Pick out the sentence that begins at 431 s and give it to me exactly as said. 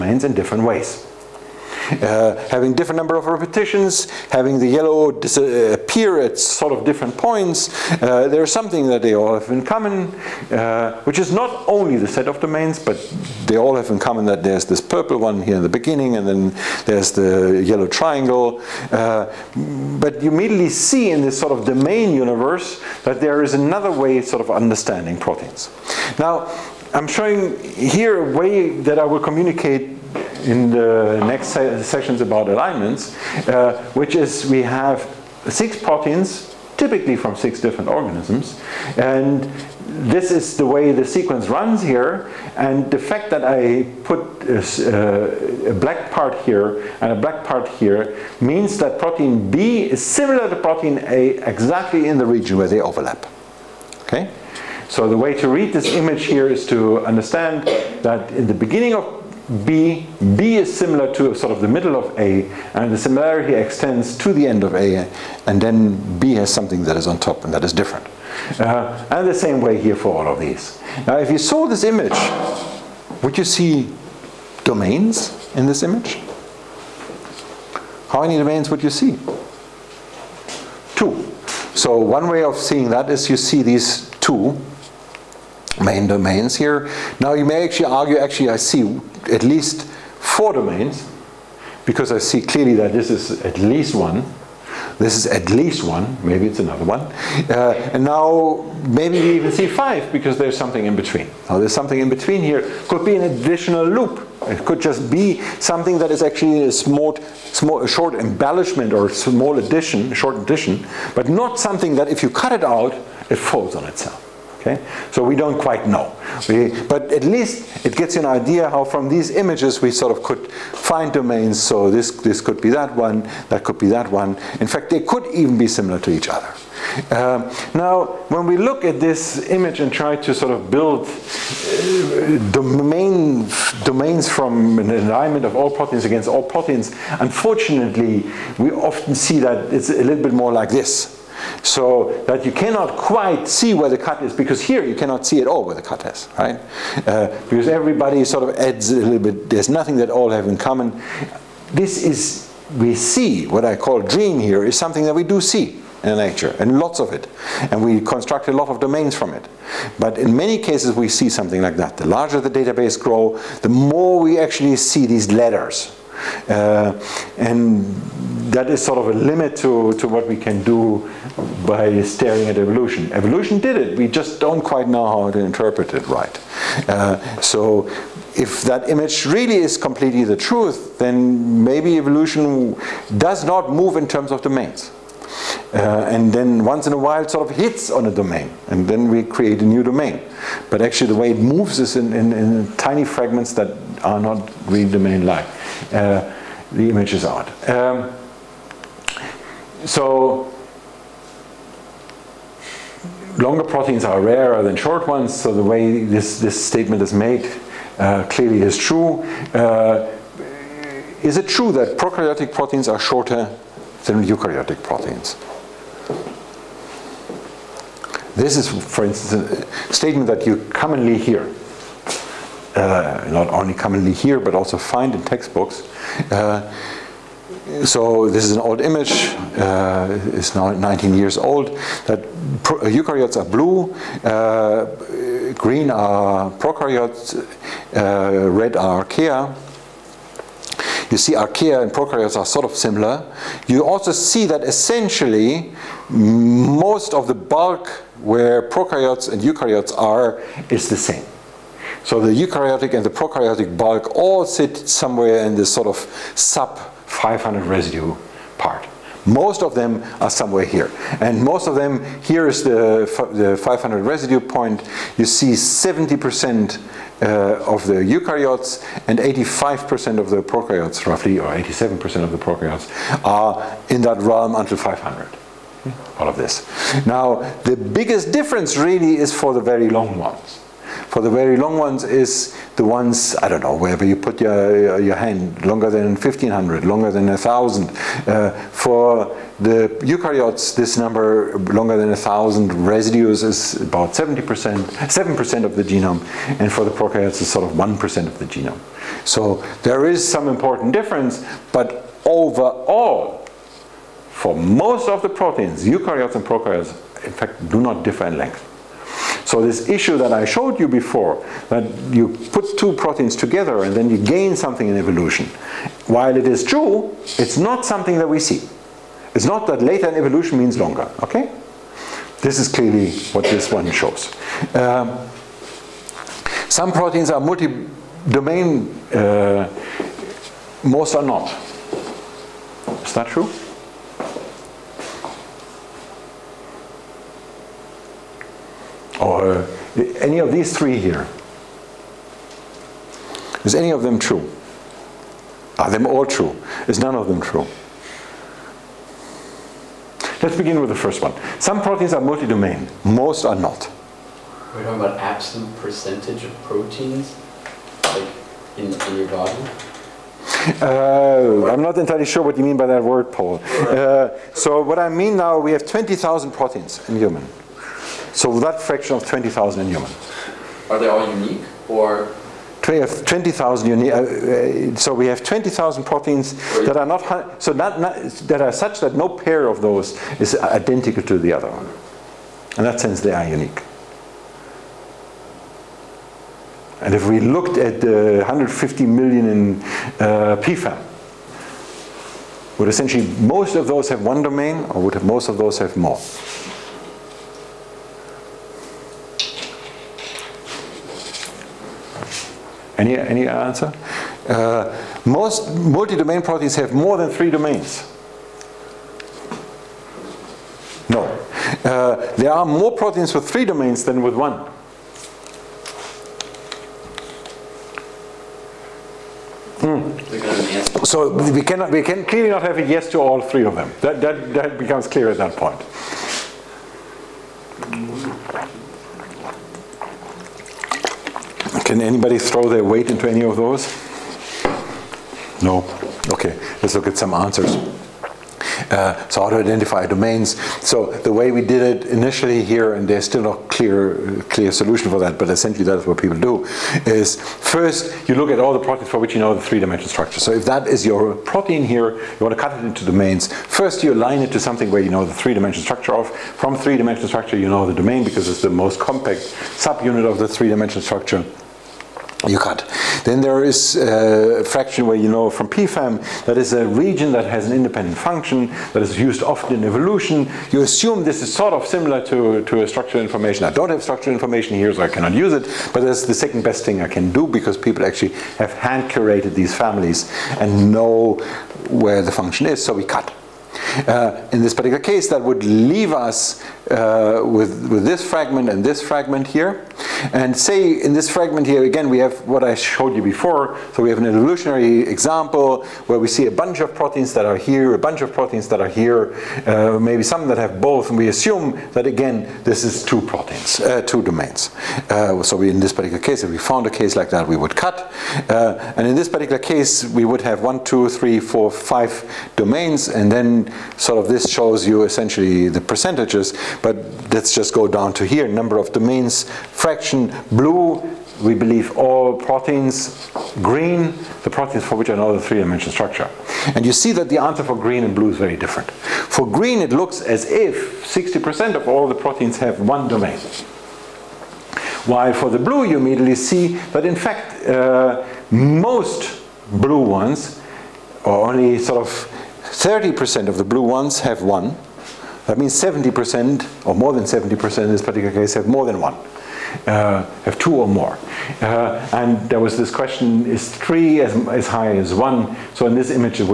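Can anybody throw their weight into any of those?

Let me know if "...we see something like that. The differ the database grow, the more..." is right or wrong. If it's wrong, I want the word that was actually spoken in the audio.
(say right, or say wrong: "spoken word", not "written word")
wrong: "larger", not "differ".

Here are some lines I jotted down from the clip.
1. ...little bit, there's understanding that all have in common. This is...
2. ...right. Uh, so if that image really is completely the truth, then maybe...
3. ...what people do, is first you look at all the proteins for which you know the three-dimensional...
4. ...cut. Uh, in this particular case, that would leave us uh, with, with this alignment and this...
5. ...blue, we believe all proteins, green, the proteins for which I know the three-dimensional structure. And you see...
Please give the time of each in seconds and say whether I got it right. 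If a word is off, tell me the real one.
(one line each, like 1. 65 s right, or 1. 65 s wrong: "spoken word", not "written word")
1. 148 s wrong: "nothing", not "understanding"
2. 176 s right
3. 446 s right
4. 483 s wrong: "fragment", not "alignment"
5. 520 s right.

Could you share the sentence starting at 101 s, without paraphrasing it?
Now there's something in between here.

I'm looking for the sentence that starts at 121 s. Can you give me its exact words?
So this, this could be that one, that could be that one.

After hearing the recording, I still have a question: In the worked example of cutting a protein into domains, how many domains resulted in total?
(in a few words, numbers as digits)
5.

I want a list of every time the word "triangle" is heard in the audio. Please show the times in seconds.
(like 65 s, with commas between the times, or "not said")
17 s.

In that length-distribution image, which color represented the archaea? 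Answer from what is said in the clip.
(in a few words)
Red.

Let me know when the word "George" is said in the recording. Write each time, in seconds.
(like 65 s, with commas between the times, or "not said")
not said.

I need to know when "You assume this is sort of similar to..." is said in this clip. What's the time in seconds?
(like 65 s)
470 s.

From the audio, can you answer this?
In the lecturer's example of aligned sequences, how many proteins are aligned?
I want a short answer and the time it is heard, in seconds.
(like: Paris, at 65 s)
6, at 35 s.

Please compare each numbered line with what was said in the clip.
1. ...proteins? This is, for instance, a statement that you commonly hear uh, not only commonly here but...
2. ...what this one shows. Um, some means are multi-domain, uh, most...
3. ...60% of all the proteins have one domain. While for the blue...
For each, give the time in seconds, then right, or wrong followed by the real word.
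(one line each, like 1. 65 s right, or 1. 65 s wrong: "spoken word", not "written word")
1. 214 s right
2. 323 s wrong: "proteins", not "means"
3. 531 s right.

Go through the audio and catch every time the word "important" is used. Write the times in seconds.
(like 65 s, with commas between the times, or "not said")
300 s.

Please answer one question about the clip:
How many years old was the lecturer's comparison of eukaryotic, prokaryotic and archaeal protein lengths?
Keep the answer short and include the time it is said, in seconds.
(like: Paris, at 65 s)
19, at 230 s.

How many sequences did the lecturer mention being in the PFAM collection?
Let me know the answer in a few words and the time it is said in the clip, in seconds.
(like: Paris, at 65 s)
150 million, at 388 s.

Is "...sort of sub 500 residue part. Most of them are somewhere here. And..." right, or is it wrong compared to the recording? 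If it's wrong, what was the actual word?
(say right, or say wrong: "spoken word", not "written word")
right.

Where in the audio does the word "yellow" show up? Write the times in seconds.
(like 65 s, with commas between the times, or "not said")
4 s, 17 s.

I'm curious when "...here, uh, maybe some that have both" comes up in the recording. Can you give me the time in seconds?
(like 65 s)
498 s.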